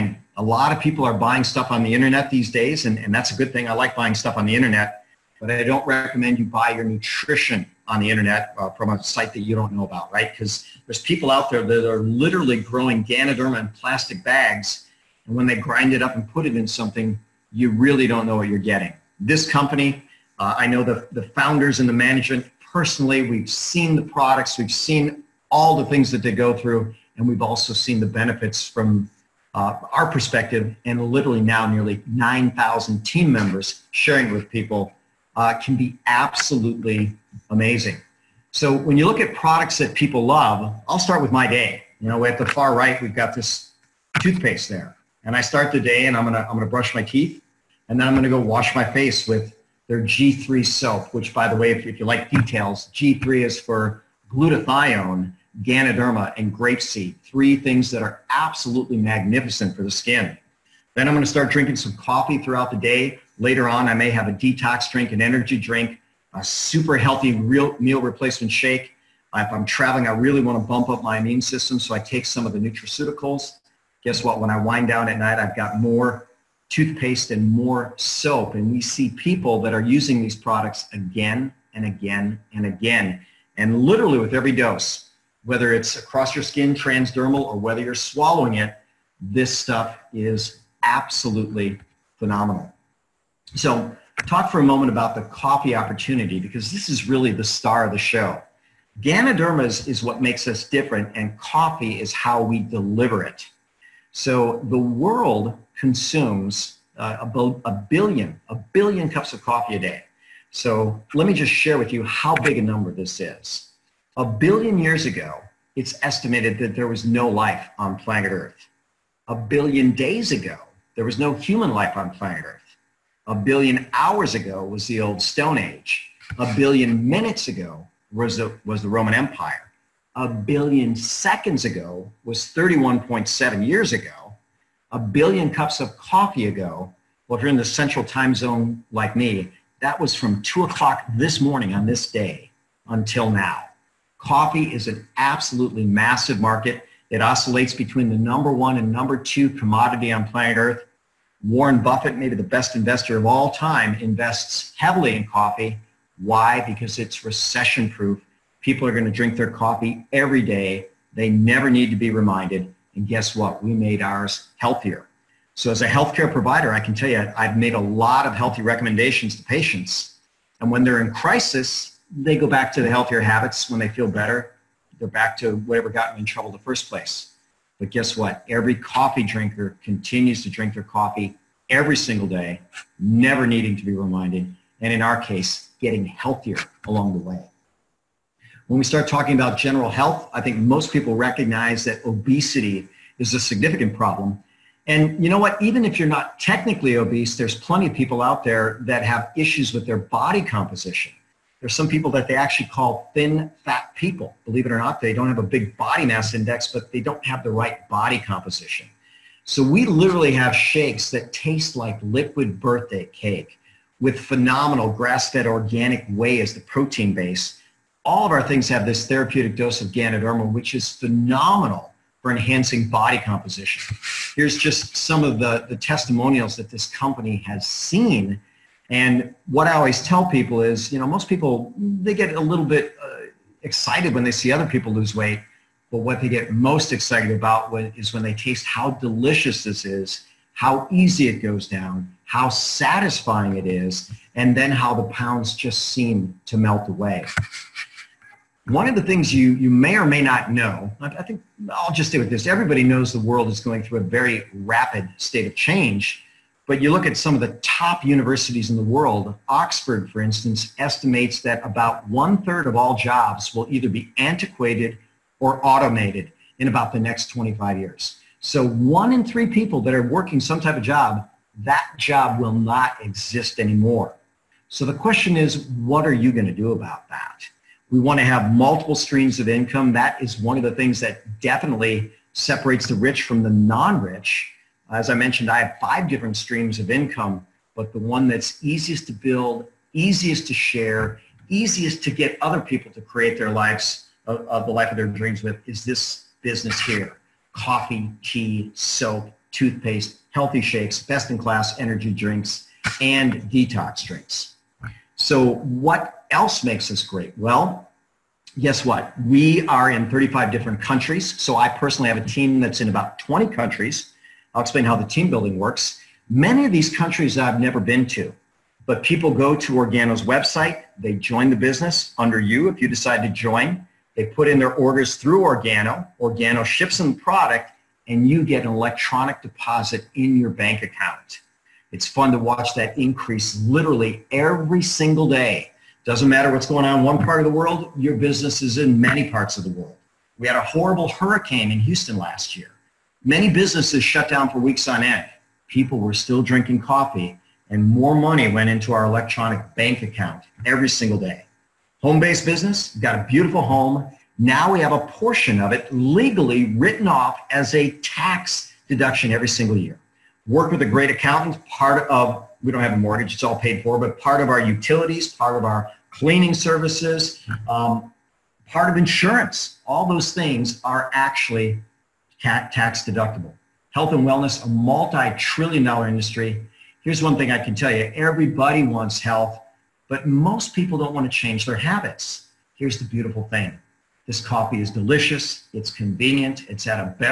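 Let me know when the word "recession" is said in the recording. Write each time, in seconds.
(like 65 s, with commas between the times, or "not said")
157 s.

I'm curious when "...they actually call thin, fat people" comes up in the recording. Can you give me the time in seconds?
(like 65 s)
202 s.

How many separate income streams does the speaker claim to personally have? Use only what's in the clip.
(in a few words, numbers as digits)
5.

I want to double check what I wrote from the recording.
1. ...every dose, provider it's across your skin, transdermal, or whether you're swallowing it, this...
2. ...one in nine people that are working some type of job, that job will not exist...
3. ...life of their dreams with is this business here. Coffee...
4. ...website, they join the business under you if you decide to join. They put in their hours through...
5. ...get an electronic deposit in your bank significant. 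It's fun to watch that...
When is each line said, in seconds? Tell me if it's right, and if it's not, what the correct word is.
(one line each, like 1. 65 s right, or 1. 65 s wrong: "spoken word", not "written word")
1. 84 s wrong: "whether", not "provider"
2. 268 s wrong: "three", not "nine"
3. 294 s right
4. 320 s wrong: "orders", not "hours"
5. 328 s wrong: "account", not "significant".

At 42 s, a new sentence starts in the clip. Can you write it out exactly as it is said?
You know, at the far right, we've got this toothpaste there.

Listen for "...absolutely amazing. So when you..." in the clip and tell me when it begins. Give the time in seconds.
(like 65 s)
36 s.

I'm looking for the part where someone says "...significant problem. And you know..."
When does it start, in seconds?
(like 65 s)
193 s.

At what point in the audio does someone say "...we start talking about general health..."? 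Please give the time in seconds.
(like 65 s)
188 s.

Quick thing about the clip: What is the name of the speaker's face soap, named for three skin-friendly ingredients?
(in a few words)
G3.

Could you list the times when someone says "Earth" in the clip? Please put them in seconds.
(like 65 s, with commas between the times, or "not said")
118 s, 122 s, 150 s.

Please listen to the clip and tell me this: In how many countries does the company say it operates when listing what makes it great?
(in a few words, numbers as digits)
35.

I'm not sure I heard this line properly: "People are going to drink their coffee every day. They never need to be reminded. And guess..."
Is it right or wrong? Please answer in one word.
right.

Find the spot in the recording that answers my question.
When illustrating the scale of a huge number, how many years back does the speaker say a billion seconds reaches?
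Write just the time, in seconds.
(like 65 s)
132 s.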